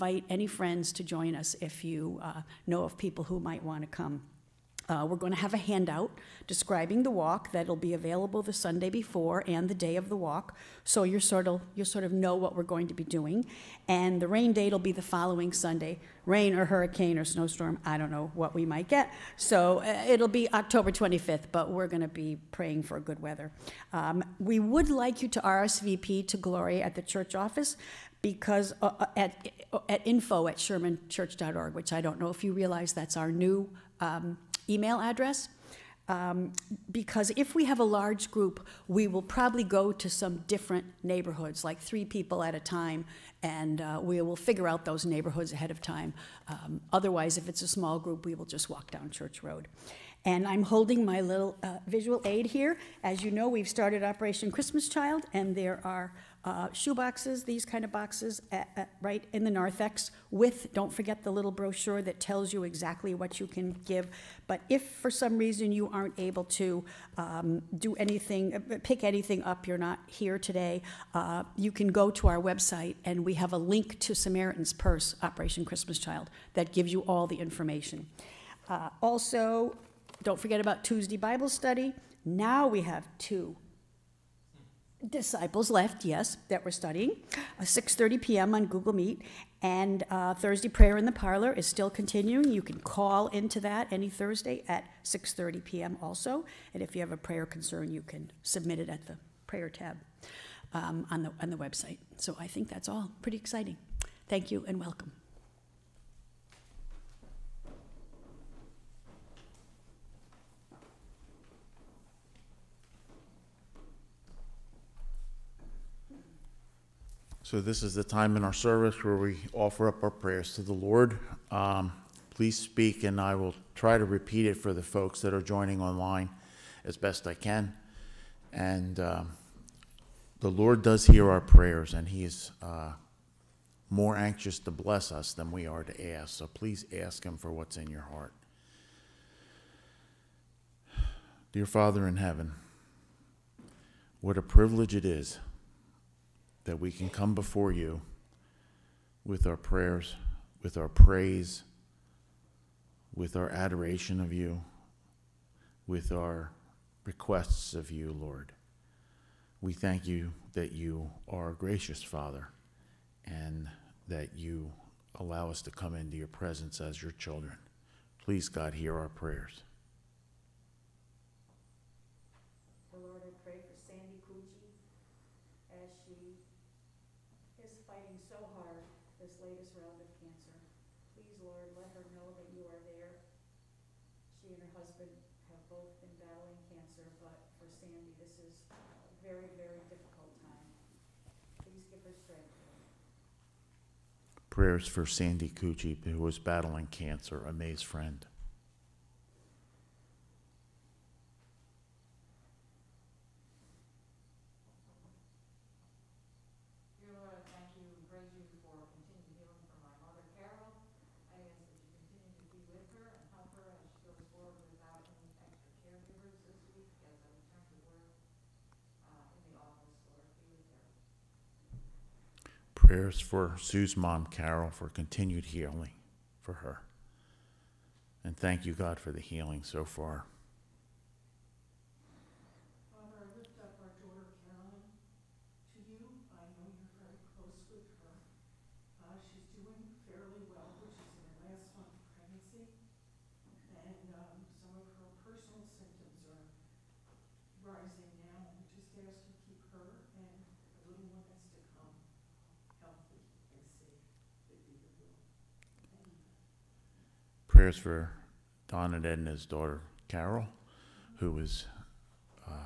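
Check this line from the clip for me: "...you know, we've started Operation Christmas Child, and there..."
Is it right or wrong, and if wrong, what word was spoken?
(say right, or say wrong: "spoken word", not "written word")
right.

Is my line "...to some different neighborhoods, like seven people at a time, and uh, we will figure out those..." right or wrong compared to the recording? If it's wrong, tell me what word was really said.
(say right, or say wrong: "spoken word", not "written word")
wrong: "three", not "seven".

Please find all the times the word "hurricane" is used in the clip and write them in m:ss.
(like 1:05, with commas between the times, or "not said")
0:16.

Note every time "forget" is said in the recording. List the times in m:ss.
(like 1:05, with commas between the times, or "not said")
1:00, 1:20.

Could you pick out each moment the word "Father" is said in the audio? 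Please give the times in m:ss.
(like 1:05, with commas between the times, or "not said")
2:21, 2:42.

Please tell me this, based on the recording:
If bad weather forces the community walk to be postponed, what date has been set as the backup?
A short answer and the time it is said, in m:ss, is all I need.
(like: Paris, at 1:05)
October 25th, at 0:20.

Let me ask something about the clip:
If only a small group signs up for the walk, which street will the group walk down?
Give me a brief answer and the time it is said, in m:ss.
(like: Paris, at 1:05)
Church Road, at 0:49.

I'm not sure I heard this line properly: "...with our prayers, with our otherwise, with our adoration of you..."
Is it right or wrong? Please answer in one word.
wrong.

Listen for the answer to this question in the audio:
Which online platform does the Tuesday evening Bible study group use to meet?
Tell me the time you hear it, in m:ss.
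1:28.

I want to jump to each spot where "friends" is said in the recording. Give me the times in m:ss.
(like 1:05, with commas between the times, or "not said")
0:00, 3:17.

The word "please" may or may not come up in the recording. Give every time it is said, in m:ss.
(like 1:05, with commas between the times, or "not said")
2:02, 2:16, 2:48.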